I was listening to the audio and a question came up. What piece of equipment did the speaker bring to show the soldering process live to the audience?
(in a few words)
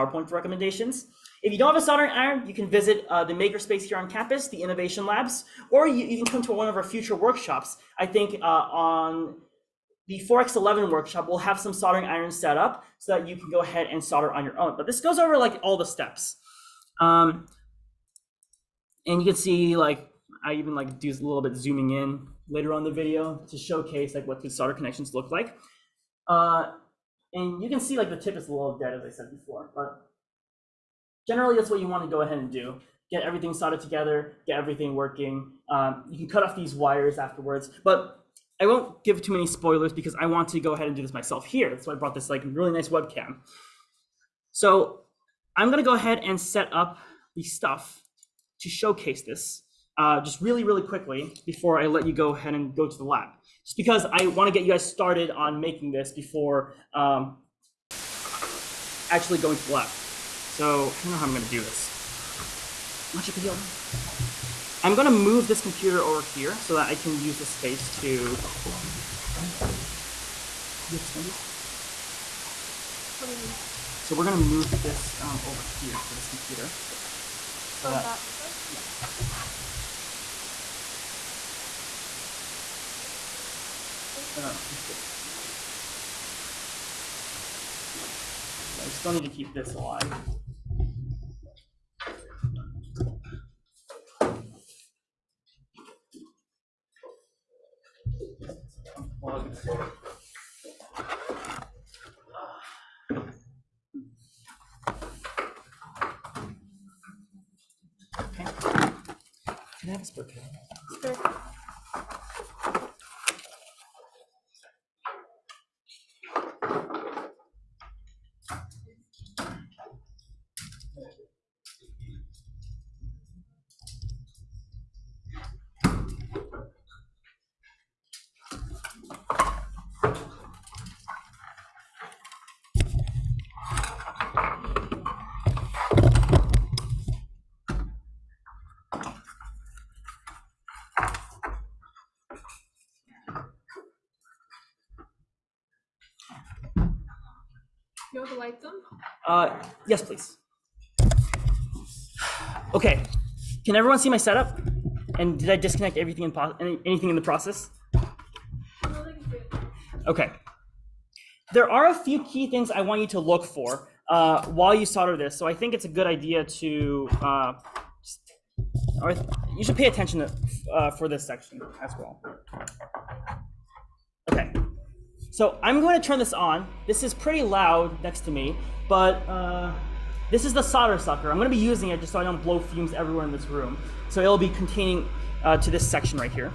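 Webcam.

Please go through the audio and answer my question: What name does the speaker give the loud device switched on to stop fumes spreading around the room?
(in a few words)
Solder sucker.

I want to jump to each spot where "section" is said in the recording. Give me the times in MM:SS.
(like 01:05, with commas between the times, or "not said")
02:51, 03:05.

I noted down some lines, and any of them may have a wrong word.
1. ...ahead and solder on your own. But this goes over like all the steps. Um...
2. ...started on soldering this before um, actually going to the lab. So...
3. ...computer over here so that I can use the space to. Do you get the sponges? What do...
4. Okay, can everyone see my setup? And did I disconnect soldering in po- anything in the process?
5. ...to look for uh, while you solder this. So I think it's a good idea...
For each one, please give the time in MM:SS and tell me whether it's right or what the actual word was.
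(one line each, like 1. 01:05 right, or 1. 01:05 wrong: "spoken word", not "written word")
1. 00:13 right
2. 00:54 wrong: "making", not "soldering"
3. 01:05 right
4. 02:32 wrong: "everything", not "soldering"
5. 02:43 right.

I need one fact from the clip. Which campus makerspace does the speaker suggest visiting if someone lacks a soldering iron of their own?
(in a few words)
Innovation Labs.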